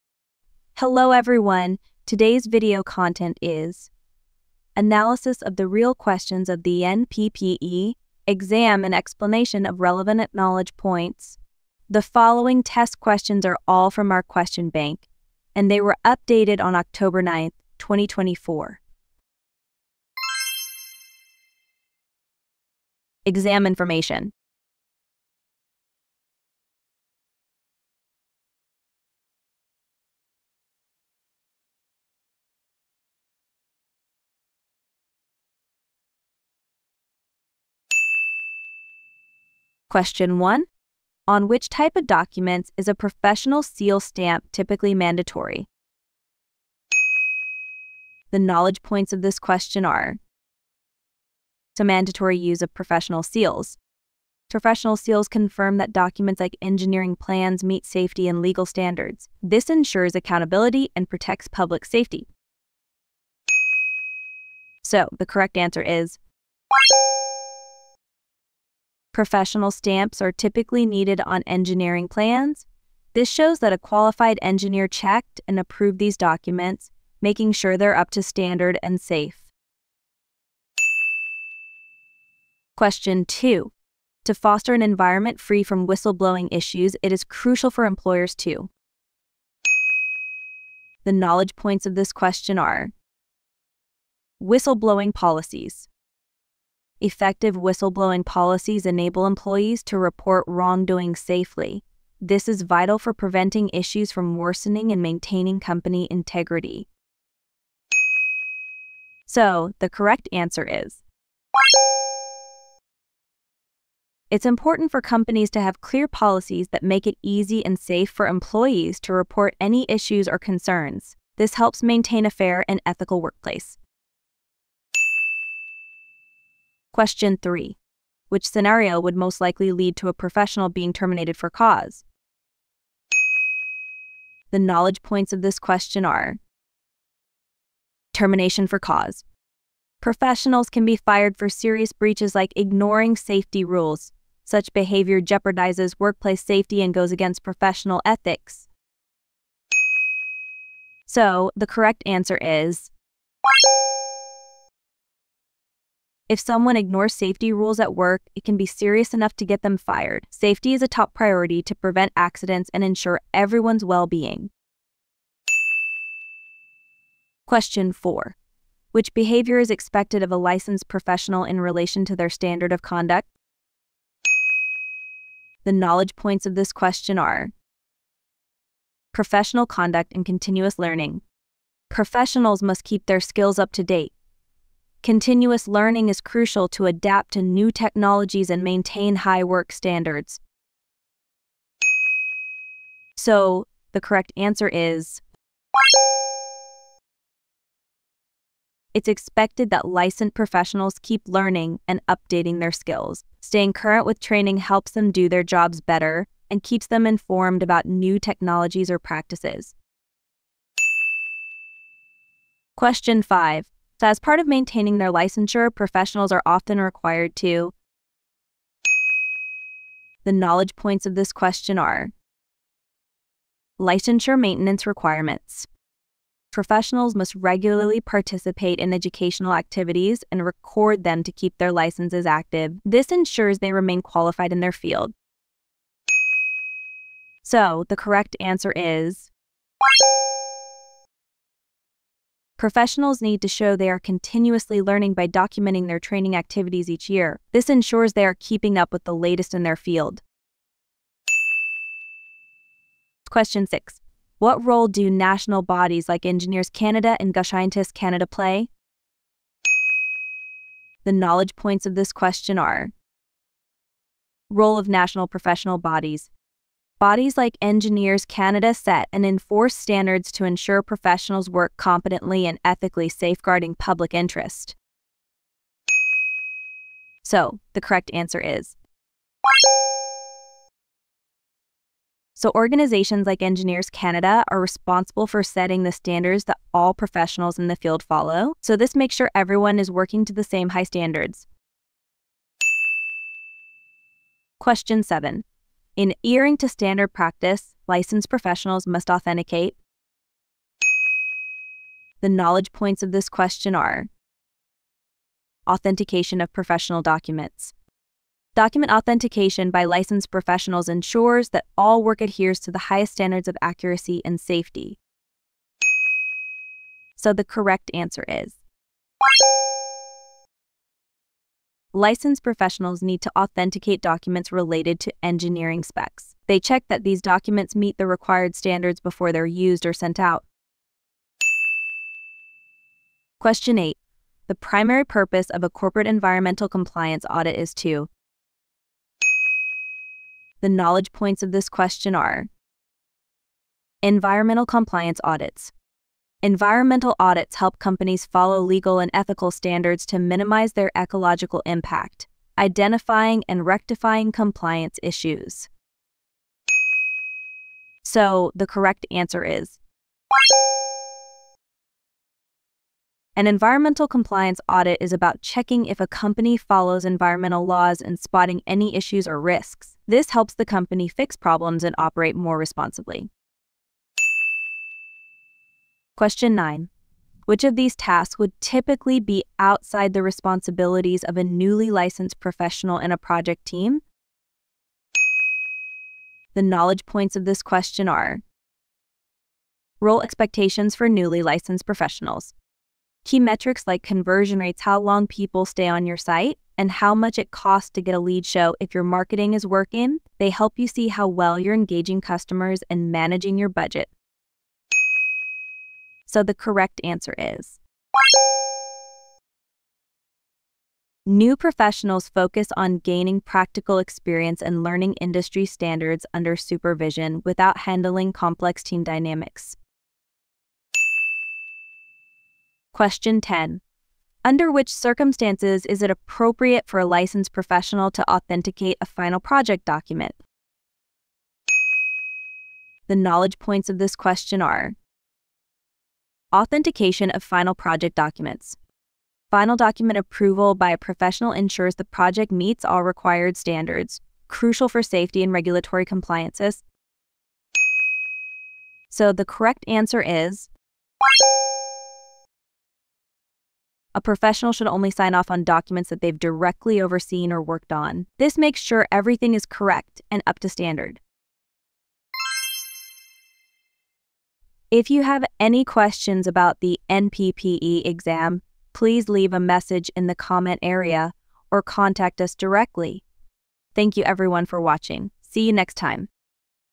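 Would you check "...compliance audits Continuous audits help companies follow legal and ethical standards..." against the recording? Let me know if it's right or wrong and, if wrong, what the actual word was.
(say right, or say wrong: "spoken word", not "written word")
wrong: "Environmental", not "Continuous".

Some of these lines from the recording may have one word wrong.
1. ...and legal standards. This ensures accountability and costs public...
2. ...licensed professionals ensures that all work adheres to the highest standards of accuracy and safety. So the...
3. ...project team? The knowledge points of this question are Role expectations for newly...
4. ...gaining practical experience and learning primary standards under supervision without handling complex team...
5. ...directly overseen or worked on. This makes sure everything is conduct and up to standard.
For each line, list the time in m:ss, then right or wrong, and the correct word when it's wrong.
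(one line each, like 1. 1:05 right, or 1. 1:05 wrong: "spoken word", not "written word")
1. 0:58 wrong: "protects", not "costs"
2. 5:09 right
3. 6:23 right
4. 6:52 wrong: "industry", not "primary"
5. 7:36 wrong: "correct", not "conduct".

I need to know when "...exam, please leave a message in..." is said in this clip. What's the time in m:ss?
7:48.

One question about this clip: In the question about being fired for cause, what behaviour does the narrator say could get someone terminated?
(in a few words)
Ignoring safety rules.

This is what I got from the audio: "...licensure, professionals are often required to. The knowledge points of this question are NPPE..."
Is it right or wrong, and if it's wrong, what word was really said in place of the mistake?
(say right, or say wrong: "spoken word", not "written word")
wrong: "Licensure", not "NPPE".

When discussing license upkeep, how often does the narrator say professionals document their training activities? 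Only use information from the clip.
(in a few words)
Each year.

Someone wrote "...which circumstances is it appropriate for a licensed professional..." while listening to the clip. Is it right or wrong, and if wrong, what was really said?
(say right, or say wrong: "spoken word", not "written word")
right.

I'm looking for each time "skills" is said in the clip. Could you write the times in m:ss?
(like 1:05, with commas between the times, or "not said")
3:03, 3:22.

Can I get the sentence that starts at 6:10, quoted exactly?
This helps the company fix problems and operate more responsibly.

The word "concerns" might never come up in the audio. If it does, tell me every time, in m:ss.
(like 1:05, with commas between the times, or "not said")
2:00.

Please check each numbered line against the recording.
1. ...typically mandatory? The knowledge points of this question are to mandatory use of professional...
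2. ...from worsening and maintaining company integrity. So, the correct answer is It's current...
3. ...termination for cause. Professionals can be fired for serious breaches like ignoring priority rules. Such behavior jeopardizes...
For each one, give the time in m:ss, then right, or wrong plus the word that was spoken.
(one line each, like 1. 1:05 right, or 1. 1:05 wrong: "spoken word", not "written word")
1. 0:44 right
2. 1:44 wrong: "important", not "current"
3. 2:18 wrong: "safety", not "priority".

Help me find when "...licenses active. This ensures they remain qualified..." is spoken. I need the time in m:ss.
3:51.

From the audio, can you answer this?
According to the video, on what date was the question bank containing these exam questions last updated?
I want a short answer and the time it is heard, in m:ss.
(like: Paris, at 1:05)
October 9, 2024, at 0:16.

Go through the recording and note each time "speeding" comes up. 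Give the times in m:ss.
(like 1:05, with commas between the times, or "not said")
not said.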